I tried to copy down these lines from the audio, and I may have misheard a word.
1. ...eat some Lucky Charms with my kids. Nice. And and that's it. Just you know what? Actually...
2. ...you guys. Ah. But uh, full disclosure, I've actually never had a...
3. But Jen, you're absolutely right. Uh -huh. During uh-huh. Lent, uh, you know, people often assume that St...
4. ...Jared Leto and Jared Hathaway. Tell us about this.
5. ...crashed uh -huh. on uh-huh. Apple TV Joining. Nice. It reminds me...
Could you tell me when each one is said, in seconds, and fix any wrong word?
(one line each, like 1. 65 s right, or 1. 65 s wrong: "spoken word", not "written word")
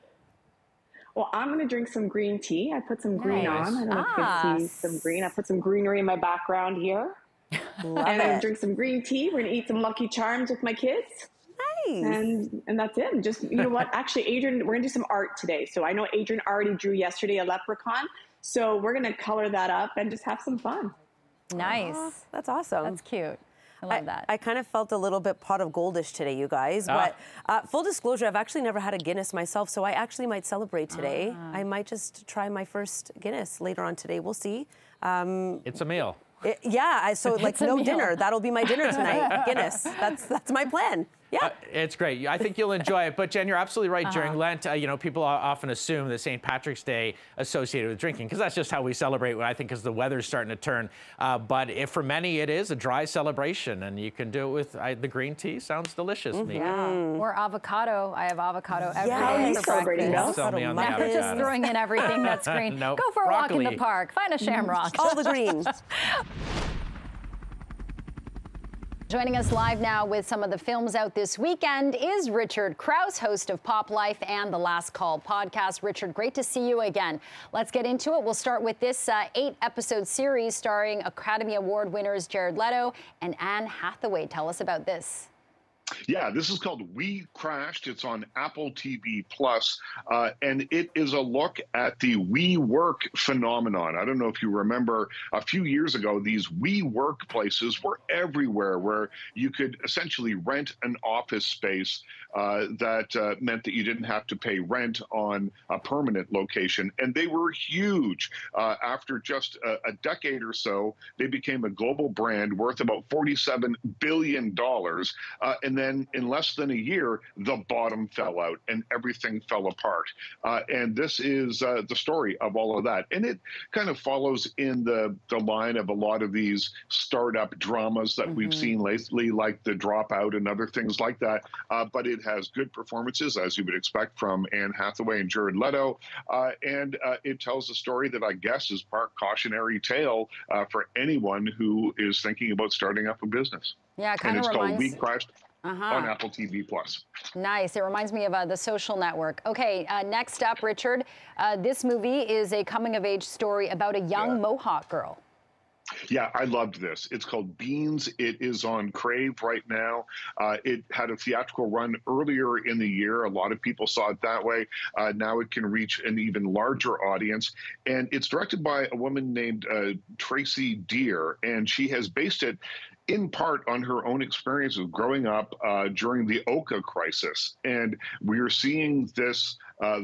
1. 9 s right
2. 26 s right
3. 43 s right
4. 82 s wrong: "Anne", not "Jared"
5. 144 s wrong: "Plus", not "Joining".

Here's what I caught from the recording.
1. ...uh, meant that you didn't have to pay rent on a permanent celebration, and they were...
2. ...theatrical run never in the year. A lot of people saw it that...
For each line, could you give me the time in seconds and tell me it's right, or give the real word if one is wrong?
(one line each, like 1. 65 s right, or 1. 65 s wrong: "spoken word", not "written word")
1. 103 s wrong: "location", not "celebration"
2. 161 s wrong: "earlier", not "never".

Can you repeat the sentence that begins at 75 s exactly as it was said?
Richard, great to see you again.